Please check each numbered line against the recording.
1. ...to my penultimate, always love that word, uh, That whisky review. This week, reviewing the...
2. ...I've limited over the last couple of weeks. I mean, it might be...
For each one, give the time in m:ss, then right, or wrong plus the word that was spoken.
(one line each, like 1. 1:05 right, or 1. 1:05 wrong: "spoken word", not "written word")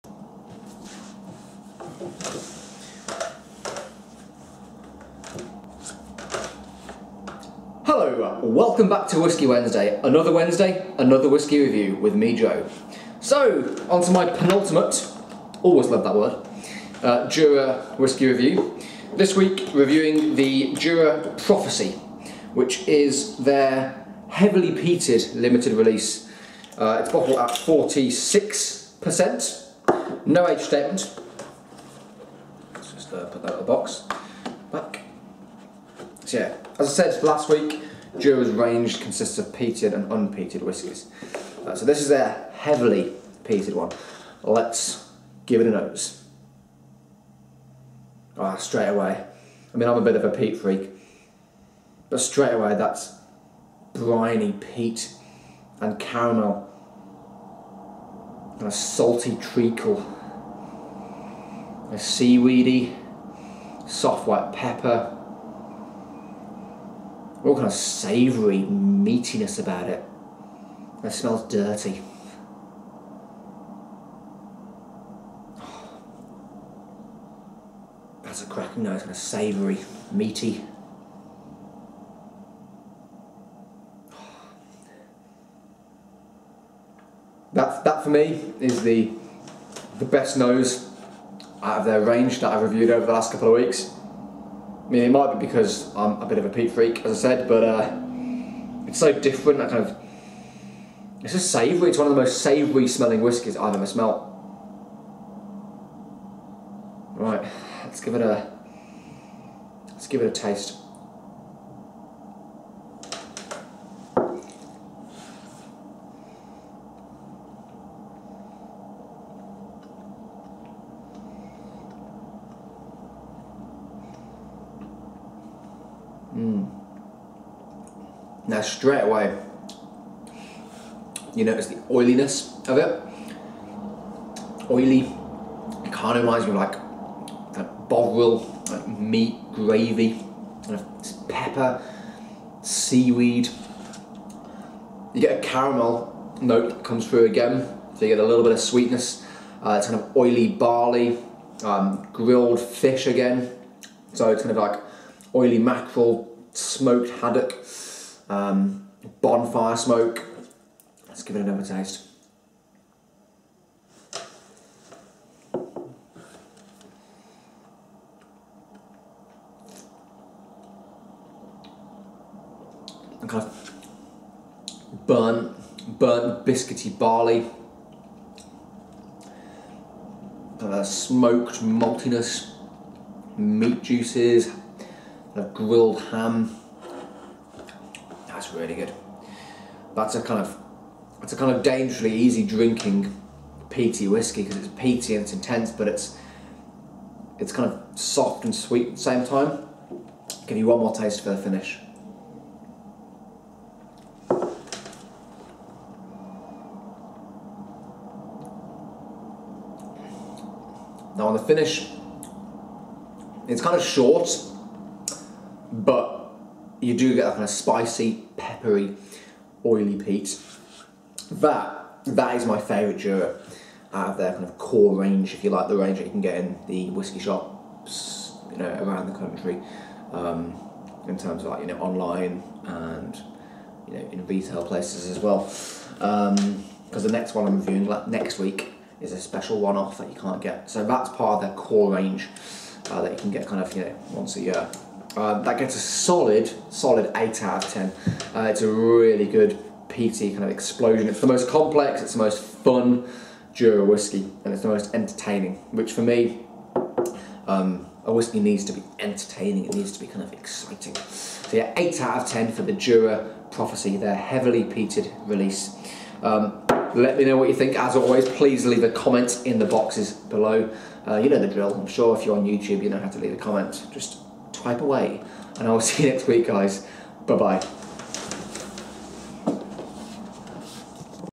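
1. 0:14 wrong: "Jura", not "That"
2. 1:32 wrong: "reviewed", not "limited".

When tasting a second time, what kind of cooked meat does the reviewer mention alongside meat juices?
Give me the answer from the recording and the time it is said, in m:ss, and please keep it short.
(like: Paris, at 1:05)
Grilled ham, at 3:05.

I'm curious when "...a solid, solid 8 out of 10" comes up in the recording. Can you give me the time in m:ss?
4:05.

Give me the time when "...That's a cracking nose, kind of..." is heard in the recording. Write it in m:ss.
1:18.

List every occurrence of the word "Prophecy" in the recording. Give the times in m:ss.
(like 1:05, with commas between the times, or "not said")
0:21, 4:23.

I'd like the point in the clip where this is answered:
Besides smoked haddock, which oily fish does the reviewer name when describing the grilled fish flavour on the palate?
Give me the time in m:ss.
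2:35.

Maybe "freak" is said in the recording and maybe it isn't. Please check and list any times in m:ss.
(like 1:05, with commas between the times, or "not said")
0:50, 1:36.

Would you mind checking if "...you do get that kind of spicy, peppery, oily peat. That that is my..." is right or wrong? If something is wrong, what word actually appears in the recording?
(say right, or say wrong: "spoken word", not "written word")
right.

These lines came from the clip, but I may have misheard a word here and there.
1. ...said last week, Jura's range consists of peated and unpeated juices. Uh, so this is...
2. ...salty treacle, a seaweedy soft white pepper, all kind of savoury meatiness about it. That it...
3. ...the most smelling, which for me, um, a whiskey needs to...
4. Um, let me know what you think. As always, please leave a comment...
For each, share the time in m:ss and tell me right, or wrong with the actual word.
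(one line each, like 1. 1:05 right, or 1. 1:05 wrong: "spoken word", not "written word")
1. 0:37 wrong: "whiskies", not "juices"
2. 0:58 right
3. 4:14 wrong: "entertaining", not "smelling"
4. 4:26 right.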